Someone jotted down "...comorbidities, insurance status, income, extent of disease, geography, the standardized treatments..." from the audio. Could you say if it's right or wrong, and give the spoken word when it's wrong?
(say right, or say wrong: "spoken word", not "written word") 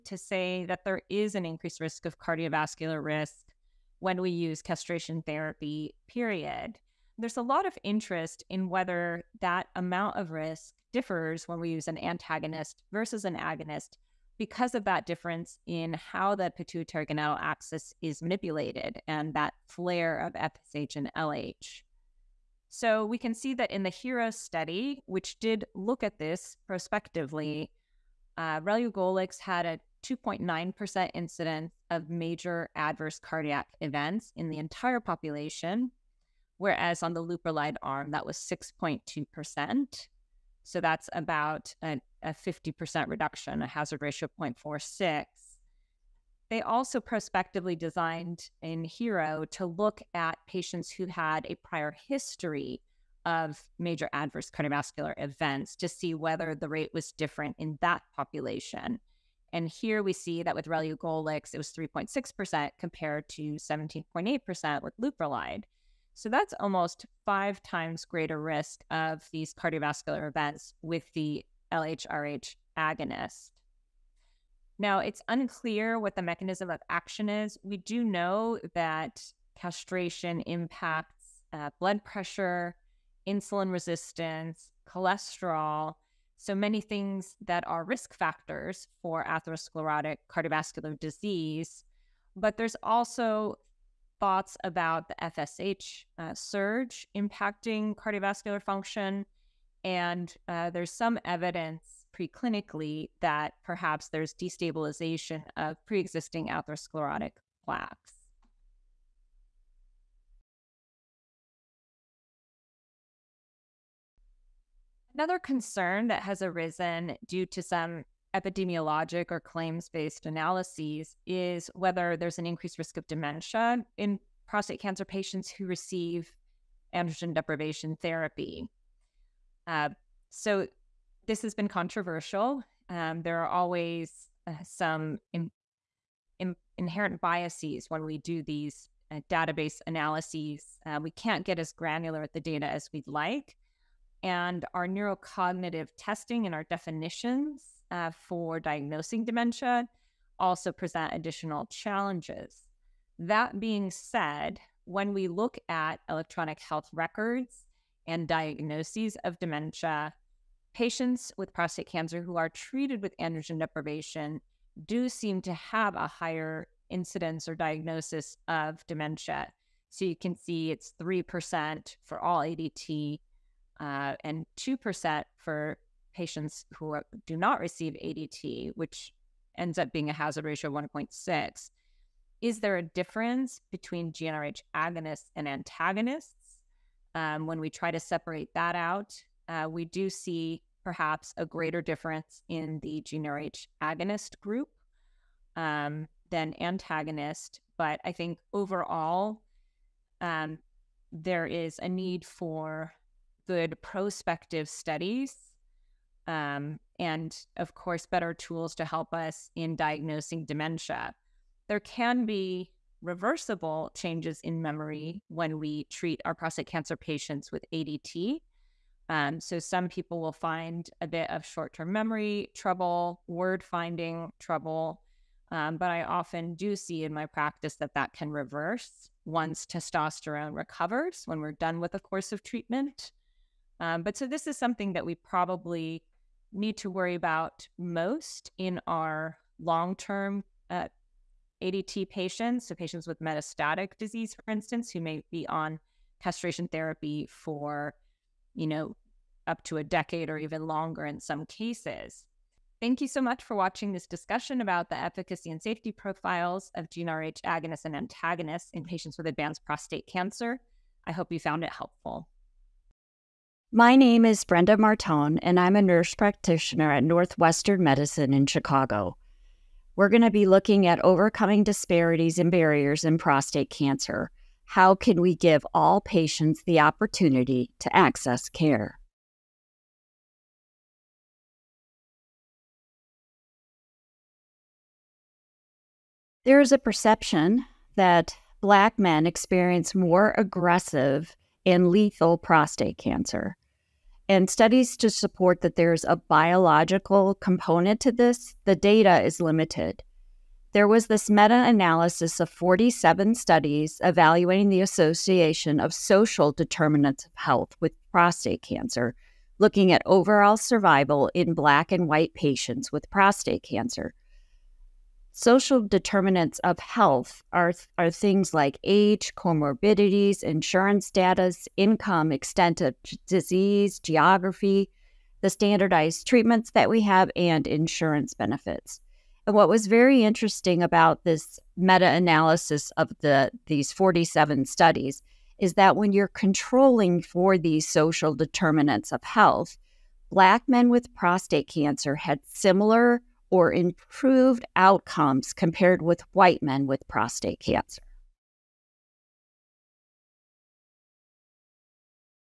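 right.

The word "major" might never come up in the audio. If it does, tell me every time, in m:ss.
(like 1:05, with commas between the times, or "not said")
0:32, 0:53.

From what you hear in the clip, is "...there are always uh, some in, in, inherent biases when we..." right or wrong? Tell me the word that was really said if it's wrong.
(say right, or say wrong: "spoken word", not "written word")
right.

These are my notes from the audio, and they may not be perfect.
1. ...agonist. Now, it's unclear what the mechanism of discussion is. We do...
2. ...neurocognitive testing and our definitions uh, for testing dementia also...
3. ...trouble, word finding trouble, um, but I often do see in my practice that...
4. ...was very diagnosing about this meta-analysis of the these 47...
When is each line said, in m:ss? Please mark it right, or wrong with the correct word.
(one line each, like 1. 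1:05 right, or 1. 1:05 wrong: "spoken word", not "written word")
1. 1:12 wrong: "action", not "discussion"
2. 2:24 wrong: "diagnosing", not "testing"
3. 3:42 right
4. 5:29 wrong: "interesting", not "diagnosing".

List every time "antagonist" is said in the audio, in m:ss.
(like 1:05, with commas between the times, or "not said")
0:11, 3:05, 3:16, 4:17.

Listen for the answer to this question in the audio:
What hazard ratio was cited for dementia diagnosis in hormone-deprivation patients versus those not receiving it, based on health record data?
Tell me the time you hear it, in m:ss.
3:00.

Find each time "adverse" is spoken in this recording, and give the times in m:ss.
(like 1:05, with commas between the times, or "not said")
0:32, 0:54.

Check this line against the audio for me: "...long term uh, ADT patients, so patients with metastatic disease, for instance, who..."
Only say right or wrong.
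right.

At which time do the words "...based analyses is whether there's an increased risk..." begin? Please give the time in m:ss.
1:59.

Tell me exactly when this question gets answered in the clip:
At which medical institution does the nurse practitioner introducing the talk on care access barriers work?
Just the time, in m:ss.
4:27.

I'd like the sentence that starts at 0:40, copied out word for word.
So that's about a 50% reduction, a hazard ratio of 0.46.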